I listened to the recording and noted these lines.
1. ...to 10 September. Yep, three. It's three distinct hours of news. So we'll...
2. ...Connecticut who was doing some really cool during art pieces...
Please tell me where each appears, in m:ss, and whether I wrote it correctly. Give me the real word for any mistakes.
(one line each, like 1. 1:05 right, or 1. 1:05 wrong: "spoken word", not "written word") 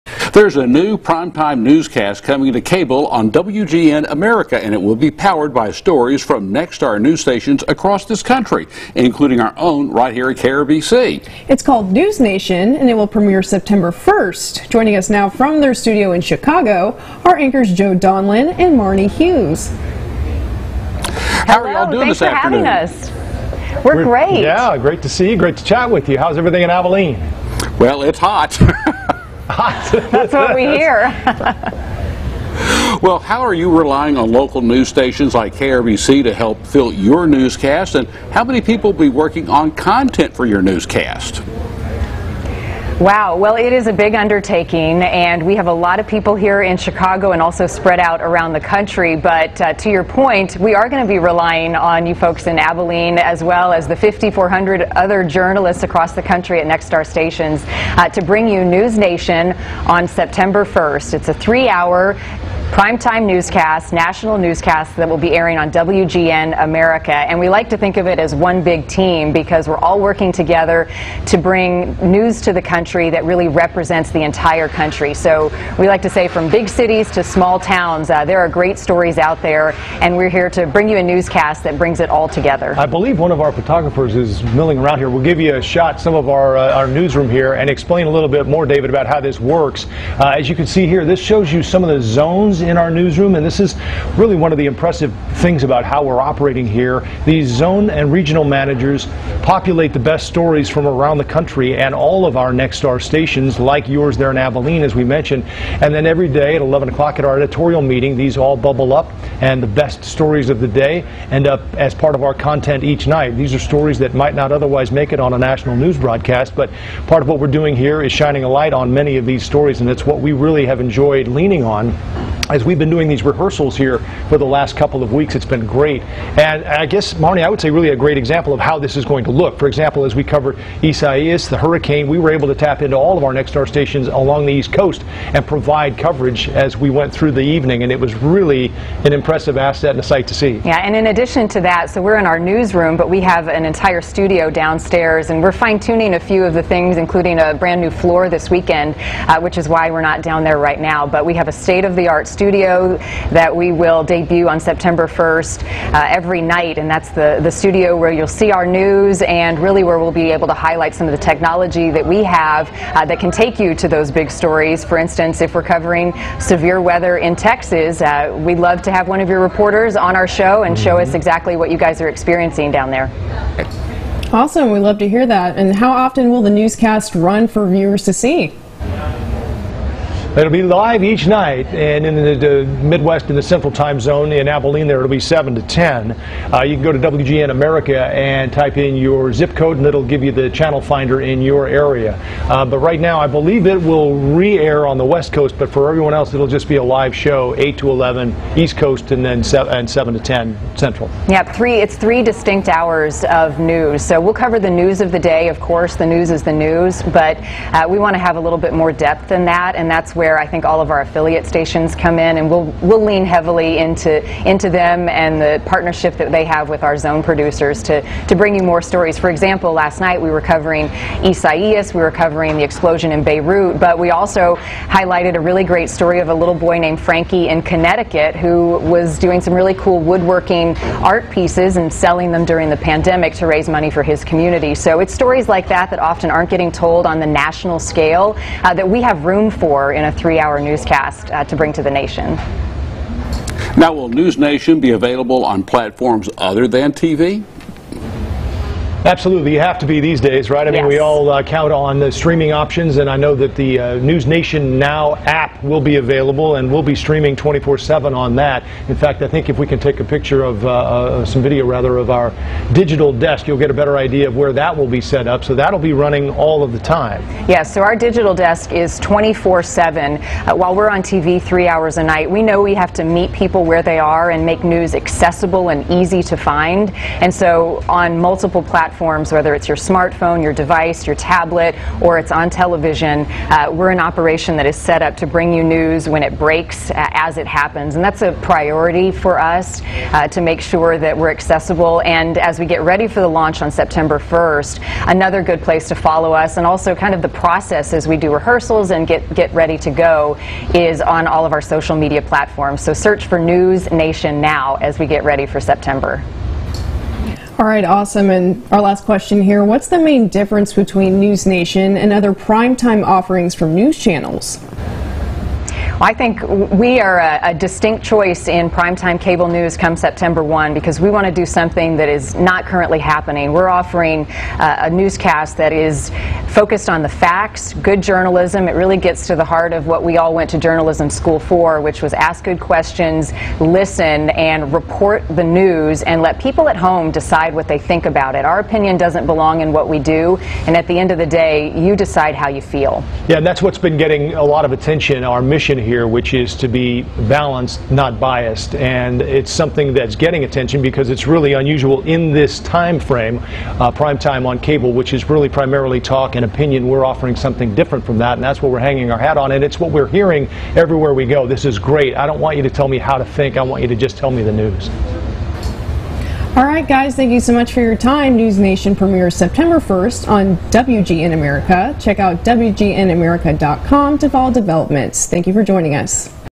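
1. 3:20 wrong: "Central", not "September"
2. 3:47 wrong: "woodworking", not "during".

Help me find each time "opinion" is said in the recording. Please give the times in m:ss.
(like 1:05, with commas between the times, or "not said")
5:38, 5:56.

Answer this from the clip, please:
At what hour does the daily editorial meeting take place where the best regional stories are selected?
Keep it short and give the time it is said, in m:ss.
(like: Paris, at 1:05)
11 o'clock, at 1:46.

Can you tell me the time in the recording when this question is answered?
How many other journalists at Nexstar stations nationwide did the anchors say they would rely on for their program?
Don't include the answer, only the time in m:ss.
0:53.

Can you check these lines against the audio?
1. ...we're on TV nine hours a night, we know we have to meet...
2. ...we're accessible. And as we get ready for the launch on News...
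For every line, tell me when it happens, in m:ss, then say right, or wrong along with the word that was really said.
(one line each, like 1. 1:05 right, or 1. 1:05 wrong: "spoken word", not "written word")
1. 4:30 wrong: "three", not "nine"
2. 4:51 wrong: "September", not "News".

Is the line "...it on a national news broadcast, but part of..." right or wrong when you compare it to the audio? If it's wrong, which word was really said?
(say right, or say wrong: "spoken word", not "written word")
right.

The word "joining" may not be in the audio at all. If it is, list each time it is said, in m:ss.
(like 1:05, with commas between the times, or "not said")
0:14, 6:15.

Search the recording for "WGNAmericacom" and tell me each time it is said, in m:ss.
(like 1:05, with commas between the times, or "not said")
6:12.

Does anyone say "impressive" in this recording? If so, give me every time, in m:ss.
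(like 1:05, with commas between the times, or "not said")
1:34, 2:19.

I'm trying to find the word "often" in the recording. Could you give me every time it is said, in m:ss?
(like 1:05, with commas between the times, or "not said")
2:55, 3:55.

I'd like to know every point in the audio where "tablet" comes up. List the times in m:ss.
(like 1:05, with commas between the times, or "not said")
4:41.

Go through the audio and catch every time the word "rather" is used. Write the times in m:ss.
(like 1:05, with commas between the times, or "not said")
4:21.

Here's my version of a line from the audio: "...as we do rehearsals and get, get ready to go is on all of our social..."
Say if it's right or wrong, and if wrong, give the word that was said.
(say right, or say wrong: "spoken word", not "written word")
right.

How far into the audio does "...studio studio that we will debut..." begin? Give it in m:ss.
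2:32.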